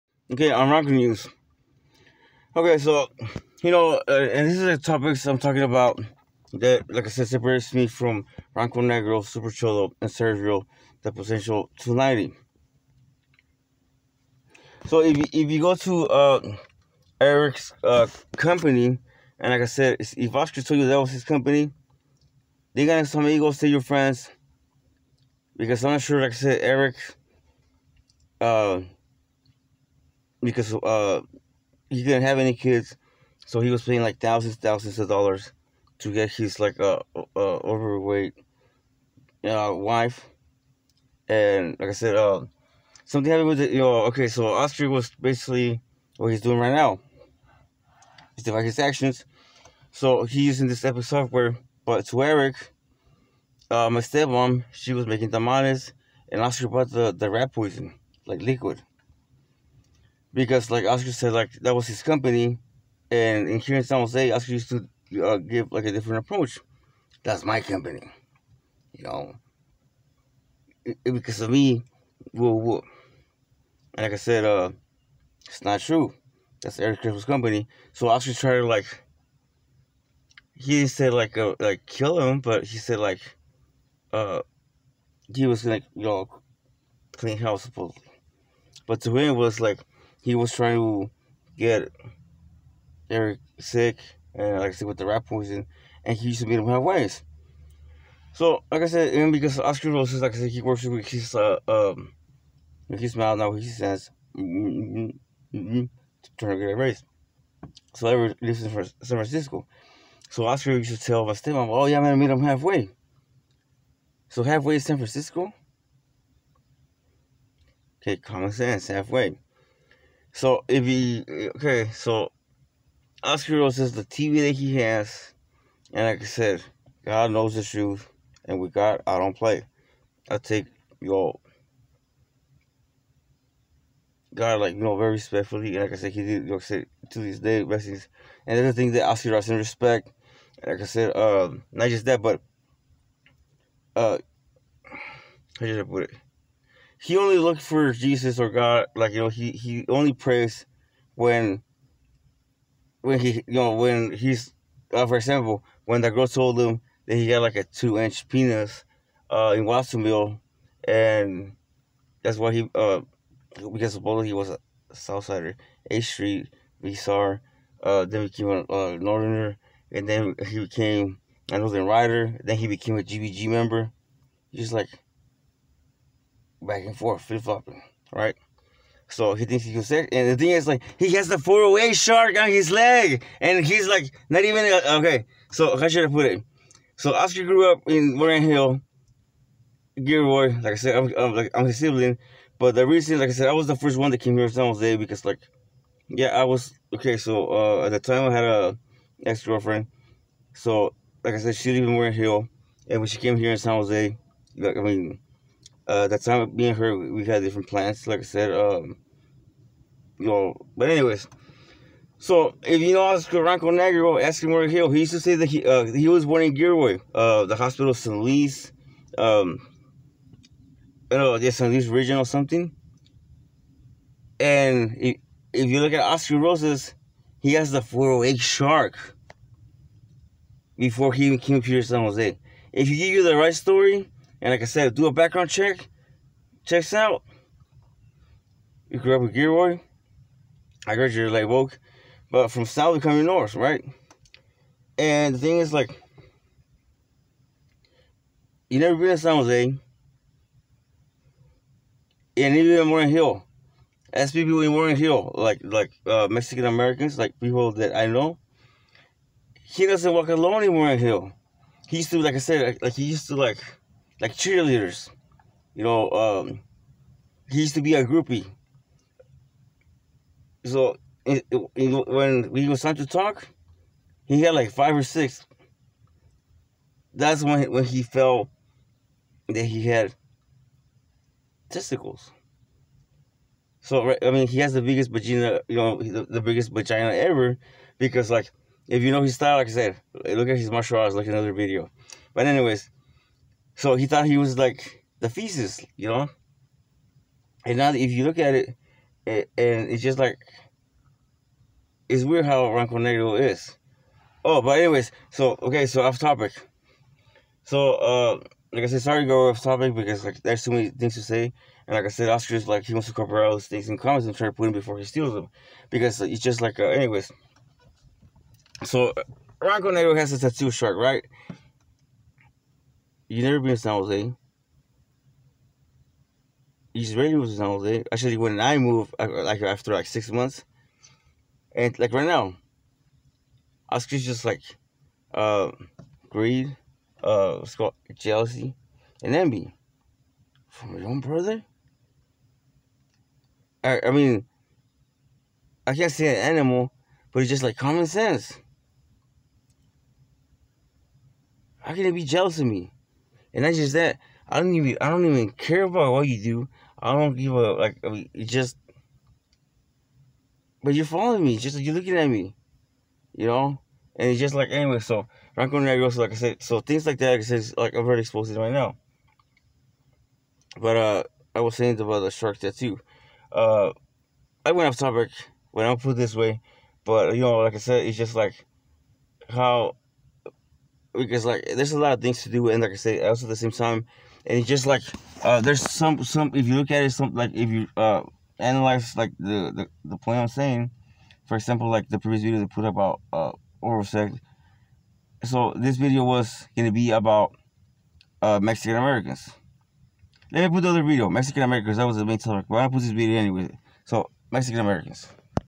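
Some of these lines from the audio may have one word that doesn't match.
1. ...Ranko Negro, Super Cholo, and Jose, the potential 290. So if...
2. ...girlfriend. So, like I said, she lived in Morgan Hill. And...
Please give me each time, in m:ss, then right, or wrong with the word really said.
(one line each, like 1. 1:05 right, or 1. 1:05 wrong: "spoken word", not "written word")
1. 0:08 wrong: "Sergio", not "Jose"
2. 3:19 right.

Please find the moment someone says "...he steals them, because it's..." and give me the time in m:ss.
5:14.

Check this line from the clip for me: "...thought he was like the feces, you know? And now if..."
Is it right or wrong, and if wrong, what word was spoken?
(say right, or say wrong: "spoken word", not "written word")
right.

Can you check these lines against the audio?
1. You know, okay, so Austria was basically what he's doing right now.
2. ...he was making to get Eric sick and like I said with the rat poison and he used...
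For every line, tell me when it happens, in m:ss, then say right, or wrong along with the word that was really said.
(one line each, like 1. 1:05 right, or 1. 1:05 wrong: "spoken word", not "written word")
1. 0:43 right
2. 1:30 wrong: "trying", not "making".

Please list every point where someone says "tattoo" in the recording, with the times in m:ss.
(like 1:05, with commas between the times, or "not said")
5:20, 6:12.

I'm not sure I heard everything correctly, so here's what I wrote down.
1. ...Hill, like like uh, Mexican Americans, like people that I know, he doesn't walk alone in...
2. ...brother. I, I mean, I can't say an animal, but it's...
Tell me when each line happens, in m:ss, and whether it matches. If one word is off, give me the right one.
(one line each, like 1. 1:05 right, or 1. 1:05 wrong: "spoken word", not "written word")
1. 4:14 right
2. 5:41 right.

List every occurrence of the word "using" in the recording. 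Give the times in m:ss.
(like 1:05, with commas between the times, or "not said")
0:50.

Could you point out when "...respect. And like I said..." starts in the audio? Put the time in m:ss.
2:19.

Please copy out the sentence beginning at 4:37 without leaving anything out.
That's when when he felt that he had testicles.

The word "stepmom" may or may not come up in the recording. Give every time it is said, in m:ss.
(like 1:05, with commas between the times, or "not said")
0:53, 1:51.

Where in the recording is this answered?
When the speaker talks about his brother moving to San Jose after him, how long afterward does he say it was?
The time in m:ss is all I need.
5:30.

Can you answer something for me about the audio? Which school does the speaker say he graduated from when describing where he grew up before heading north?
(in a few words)
Live Oak.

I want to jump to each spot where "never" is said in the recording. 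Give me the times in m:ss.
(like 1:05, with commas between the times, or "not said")
4:08, 5:23.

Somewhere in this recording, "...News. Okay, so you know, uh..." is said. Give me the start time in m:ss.
0:00.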